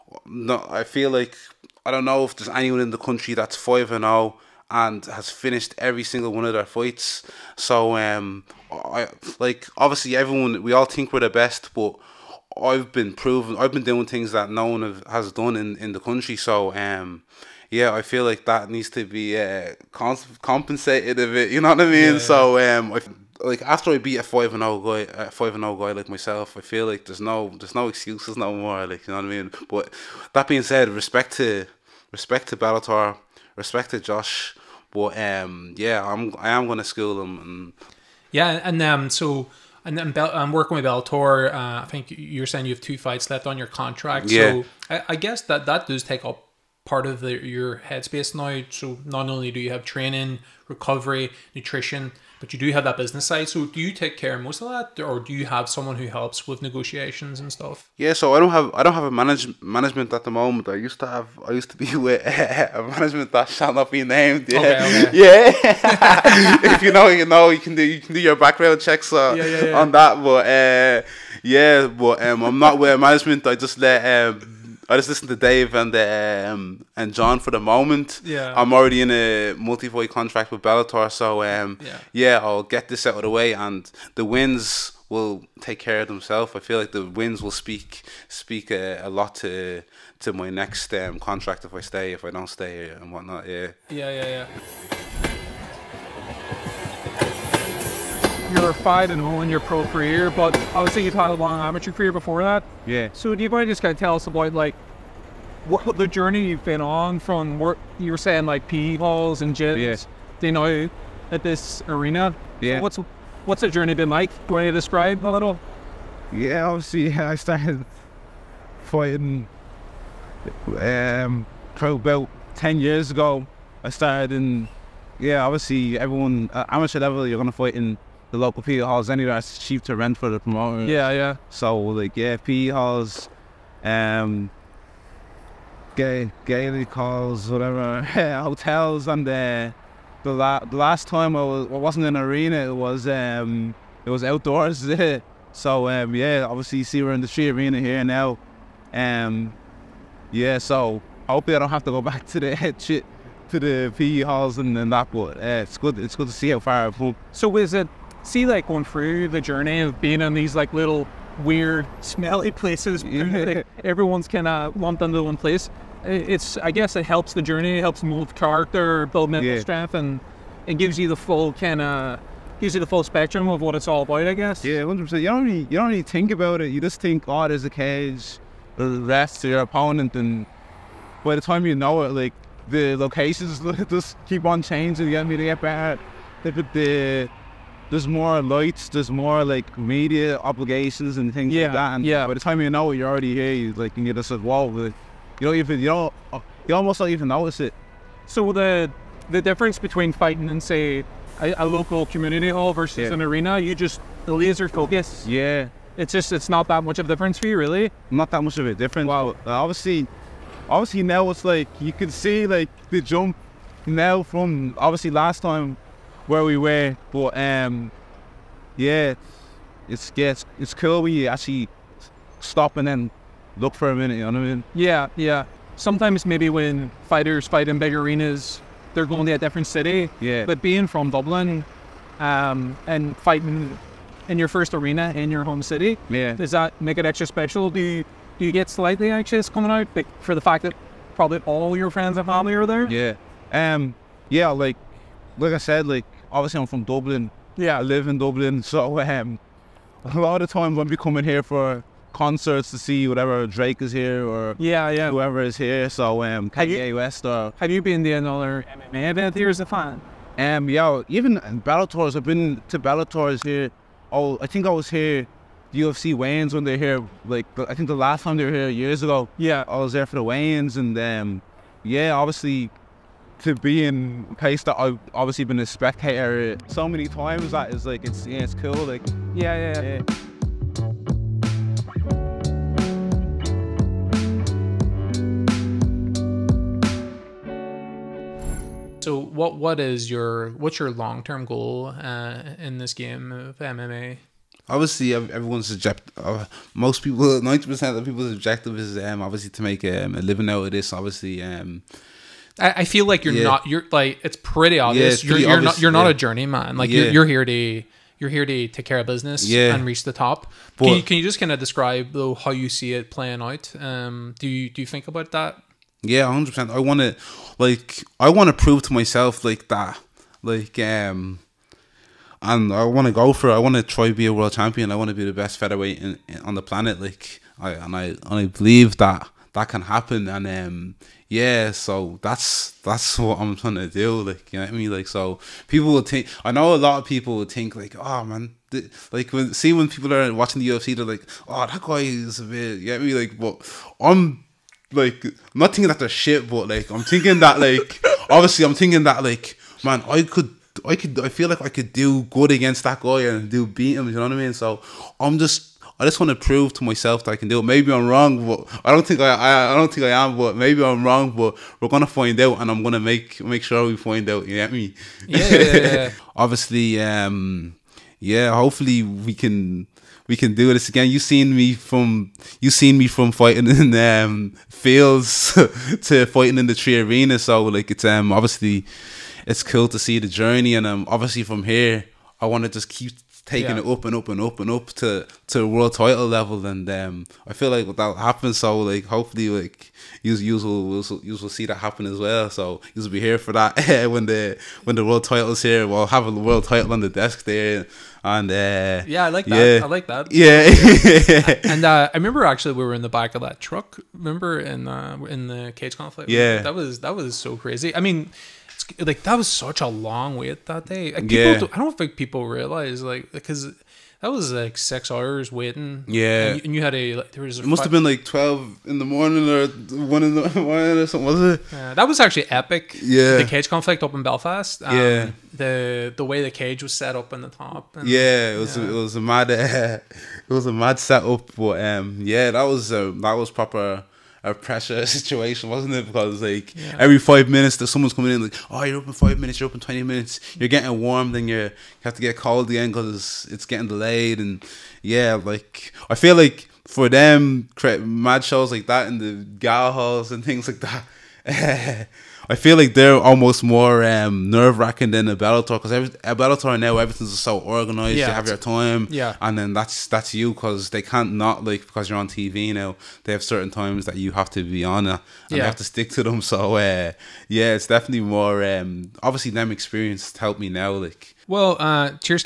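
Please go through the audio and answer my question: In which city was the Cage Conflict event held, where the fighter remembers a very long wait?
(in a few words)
Belfast.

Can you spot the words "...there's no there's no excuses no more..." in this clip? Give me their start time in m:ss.
0:27.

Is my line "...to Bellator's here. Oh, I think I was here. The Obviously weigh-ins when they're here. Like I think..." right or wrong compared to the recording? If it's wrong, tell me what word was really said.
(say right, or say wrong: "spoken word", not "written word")
wrong: "UFC", not "Obviously".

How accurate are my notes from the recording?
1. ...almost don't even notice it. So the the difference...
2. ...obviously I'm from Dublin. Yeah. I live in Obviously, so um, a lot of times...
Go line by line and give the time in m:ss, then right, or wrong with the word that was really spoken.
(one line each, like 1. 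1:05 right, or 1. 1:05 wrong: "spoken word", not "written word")
1. 3:16 right
2. 4:06 wrong: "Dublin", not "Obviously".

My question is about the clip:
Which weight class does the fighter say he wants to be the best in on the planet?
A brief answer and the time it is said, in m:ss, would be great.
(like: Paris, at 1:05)
Featherweight, at 5:25.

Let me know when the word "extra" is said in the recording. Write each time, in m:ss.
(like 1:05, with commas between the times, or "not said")
3:57.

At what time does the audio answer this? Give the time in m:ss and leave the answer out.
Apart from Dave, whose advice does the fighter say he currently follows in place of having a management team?
1:17.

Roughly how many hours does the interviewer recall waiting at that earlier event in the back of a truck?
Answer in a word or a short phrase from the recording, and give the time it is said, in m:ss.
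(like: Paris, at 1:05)
6 hours, at 6:54.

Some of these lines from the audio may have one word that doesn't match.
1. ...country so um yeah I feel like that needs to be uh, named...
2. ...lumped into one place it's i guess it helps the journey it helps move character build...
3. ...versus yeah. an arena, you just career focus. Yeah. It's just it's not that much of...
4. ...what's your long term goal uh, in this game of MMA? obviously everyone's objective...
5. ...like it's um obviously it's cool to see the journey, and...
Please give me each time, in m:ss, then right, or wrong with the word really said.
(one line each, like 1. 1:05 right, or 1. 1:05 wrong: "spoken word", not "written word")
1. 0:15 wrong: "compensated", not "named"
2. 2:44 right
3. 3:22 wrong: "laser", not "career"
4. 4:50 right
5. 6:17 right.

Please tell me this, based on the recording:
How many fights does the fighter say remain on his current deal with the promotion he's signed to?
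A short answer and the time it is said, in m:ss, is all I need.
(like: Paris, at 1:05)
2, at 0:42.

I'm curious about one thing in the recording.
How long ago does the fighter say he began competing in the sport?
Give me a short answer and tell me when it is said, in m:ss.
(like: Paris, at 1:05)
10 years ago, at 2:02.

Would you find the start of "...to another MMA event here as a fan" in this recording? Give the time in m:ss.
4:18.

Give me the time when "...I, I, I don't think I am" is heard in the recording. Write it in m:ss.
5:59.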